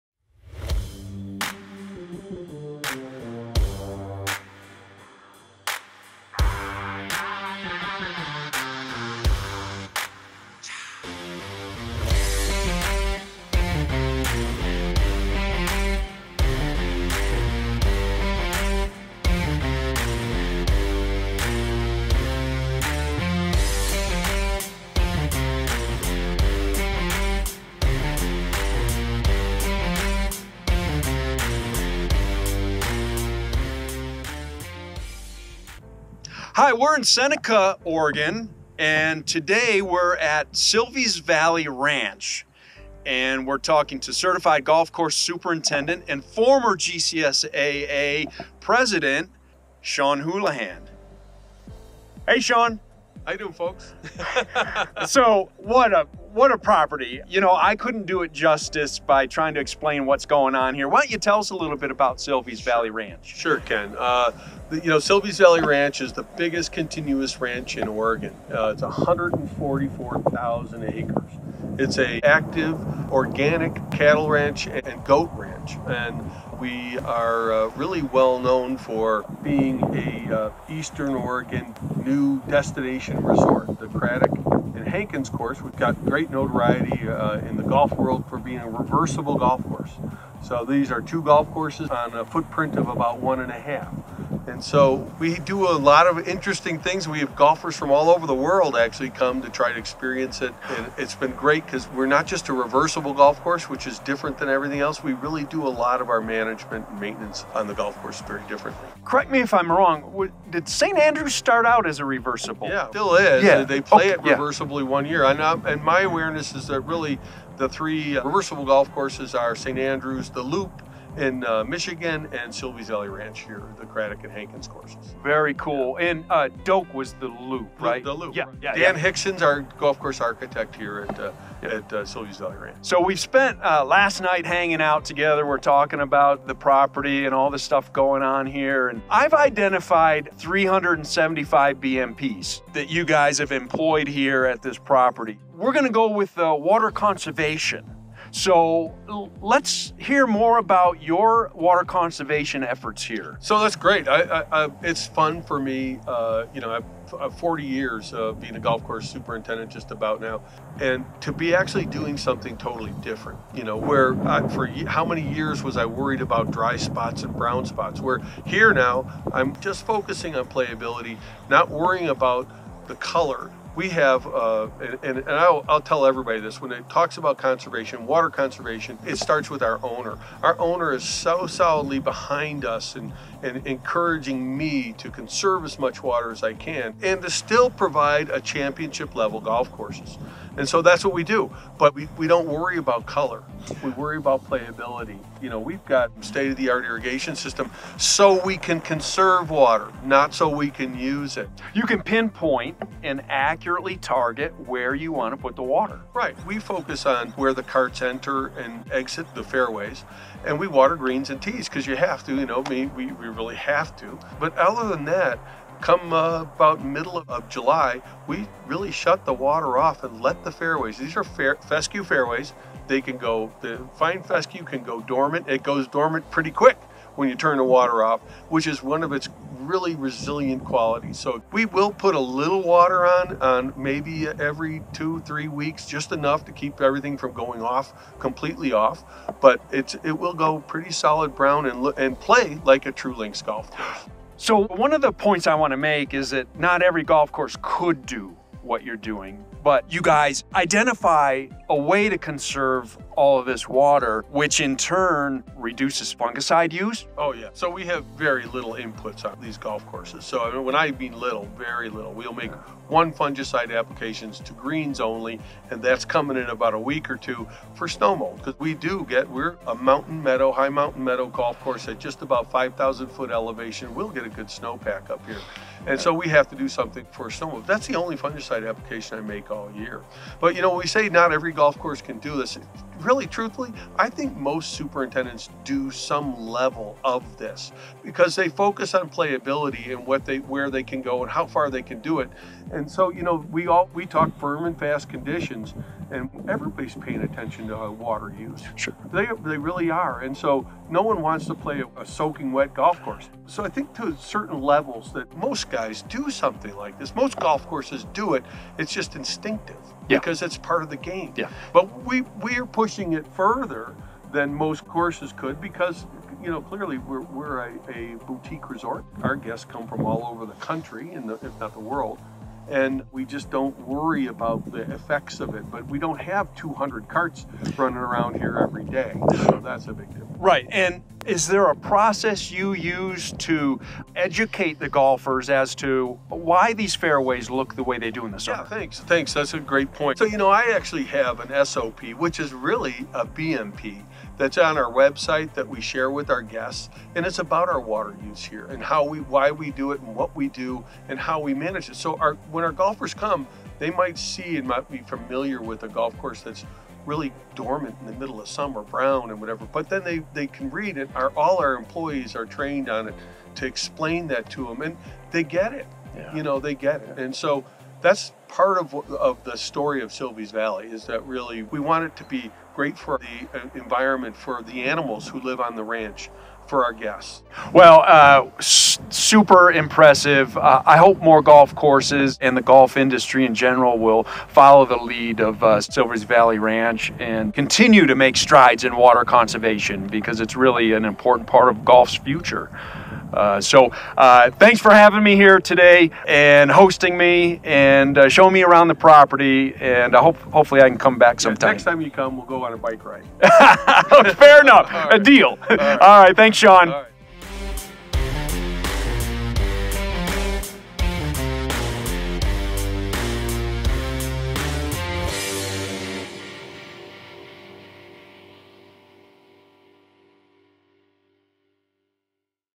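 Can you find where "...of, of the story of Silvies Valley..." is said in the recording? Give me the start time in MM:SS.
06:08.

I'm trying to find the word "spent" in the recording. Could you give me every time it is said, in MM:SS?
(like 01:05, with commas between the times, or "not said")
02:13.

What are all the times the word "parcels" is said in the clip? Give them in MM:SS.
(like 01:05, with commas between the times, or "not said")
not said.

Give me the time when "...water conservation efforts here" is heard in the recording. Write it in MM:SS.
02:31.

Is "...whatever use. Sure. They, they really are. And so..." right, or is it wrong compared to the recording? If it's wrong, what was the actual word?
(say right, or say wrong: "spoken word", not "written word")
wrong: "water", not "whatever".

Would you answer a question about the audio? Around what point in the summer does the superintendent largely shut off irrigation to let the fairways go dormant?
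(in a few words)
middle of July.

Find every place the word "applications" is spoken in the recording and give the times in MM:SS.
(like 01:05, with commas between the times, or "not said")
04:23, 04:38.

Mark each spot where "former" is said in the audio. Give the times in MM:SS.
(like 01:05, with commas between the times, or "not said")
00:46.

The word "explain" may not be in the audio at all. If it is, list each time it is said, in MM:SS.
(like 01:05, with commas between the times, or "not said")
00:59, 06:03.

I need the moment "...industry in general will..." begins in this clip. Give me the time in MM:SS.
06:22.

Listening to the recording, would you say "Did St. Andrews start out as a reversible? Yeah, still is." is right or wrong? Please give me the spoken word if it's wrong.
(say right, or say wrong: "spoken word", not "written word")
right.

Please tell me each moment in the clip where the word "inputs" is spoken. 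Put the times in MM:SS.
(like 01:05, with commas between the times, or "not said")
04:18.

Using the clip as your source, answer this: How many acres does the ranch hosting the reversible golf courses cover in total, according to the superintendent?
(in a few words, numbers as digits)
144,000.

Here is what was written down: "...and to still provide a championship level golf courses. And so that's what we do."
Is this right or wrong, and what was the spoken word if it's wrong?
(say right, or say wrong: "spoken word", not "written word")
right.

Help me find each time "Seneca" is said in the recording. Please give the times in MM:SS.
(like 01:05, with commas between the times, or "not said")
00:37.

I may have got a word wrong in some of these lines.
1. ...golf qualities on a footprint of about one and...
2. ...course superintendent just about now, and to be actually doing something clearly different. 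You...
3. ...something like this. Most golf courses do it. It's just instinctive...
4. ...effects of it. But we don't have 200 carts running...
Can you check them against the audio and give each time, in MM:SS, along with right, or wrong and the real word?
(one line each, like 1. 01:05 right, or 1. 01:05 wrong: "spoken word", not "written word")
1. 01:31 wrong: "courses", not "qualities"
2. 02:38 wrong: "totally", not "clearly"
3. 05:06 right
4. 05:24 right.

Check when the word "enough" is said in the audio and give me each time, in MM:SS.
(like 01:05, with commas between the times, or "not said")
03:56, 06:44.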